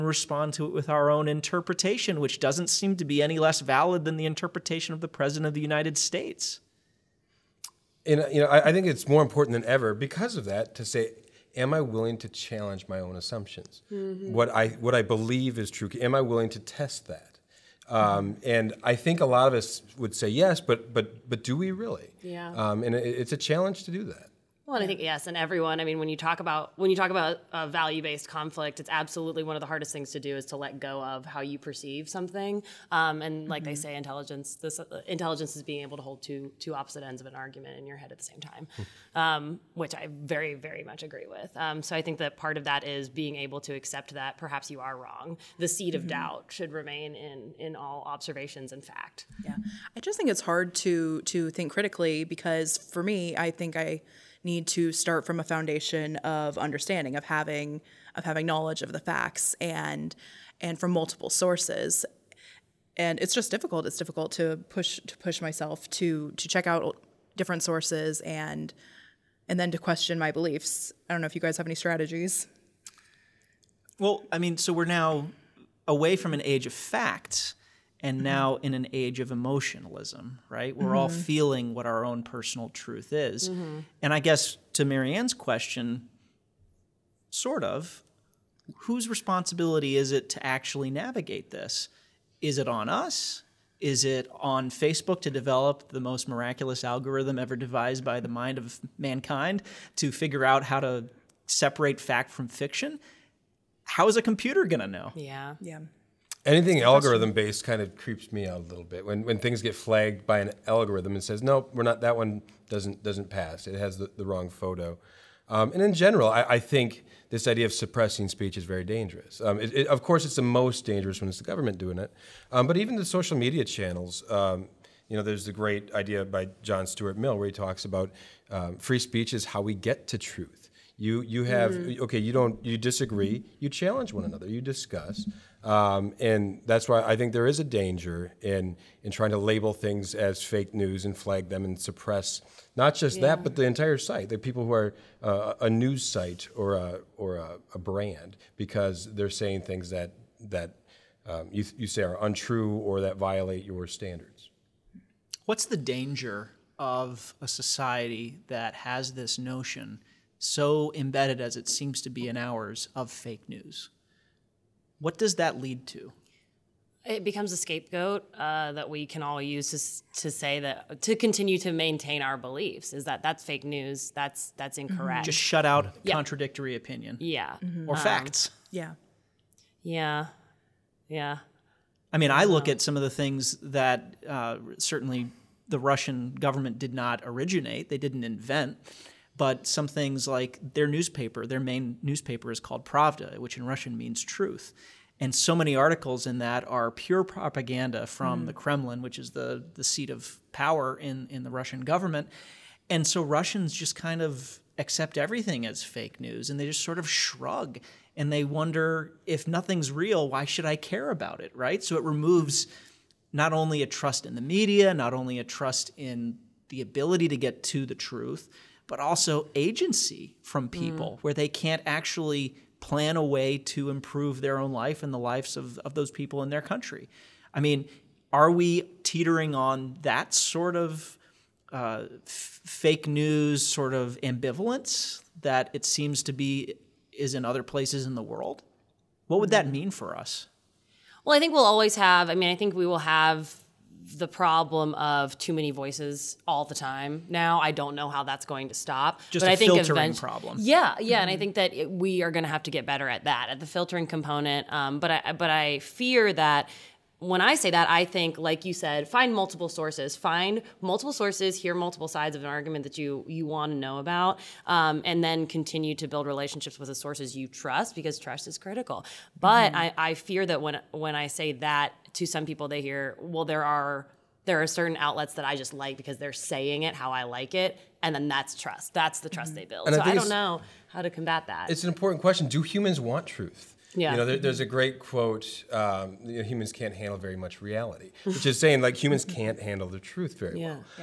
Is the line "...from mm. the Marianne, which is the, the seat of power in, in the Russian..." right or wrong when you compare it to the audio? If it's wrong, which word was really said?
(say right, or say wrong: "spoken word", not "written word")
wrong: "Kremlin", not "Marianne".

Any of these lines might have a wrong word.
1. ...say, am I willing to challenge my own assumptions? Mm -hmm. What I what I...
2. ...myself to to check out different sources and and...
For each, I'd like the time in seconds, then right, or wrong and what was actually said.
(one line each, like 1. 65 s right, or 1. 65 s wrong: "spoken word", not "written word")
1. 10 s right
2. 65 s right.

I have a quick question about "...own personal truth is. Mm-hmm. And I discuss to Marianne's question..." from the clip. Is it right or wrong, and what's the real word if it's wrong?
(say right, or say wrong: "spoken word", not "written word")
wrong: "guess", not "discuss".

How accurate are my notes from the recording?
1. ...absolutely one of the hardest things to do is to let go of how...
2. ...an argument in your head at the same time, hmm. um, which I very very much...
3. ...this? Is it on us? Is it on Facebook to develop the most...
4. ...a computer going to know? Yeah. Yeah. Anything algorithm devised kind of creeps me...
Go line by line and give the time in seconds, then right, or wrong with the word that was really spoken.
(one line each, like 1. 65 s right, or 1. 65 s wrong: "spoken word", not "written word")
1. 28 s right
2. 37 s right
3. 91 s right
4. 104 s wrong: "based", not "devised".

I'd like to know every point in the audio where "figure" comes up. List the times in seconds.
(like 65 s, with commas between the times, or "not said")
100 s.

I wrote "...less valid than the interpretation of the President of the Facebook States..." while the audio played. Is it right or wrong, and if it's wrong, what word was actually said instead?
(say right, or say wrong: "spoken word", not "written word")
wrong: "United", not "Facebook".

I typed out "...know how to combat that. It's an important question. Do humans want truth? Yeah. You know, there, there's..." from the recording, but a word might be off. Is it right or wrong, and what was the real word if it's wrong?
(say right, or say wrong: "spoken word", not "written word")
right.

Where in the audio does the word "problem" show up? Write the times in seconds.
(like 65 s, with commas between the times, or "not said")
244 s, 250 s.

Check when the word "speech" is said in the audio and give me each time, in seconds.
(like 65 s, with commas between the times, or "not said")
118 s, 128 s.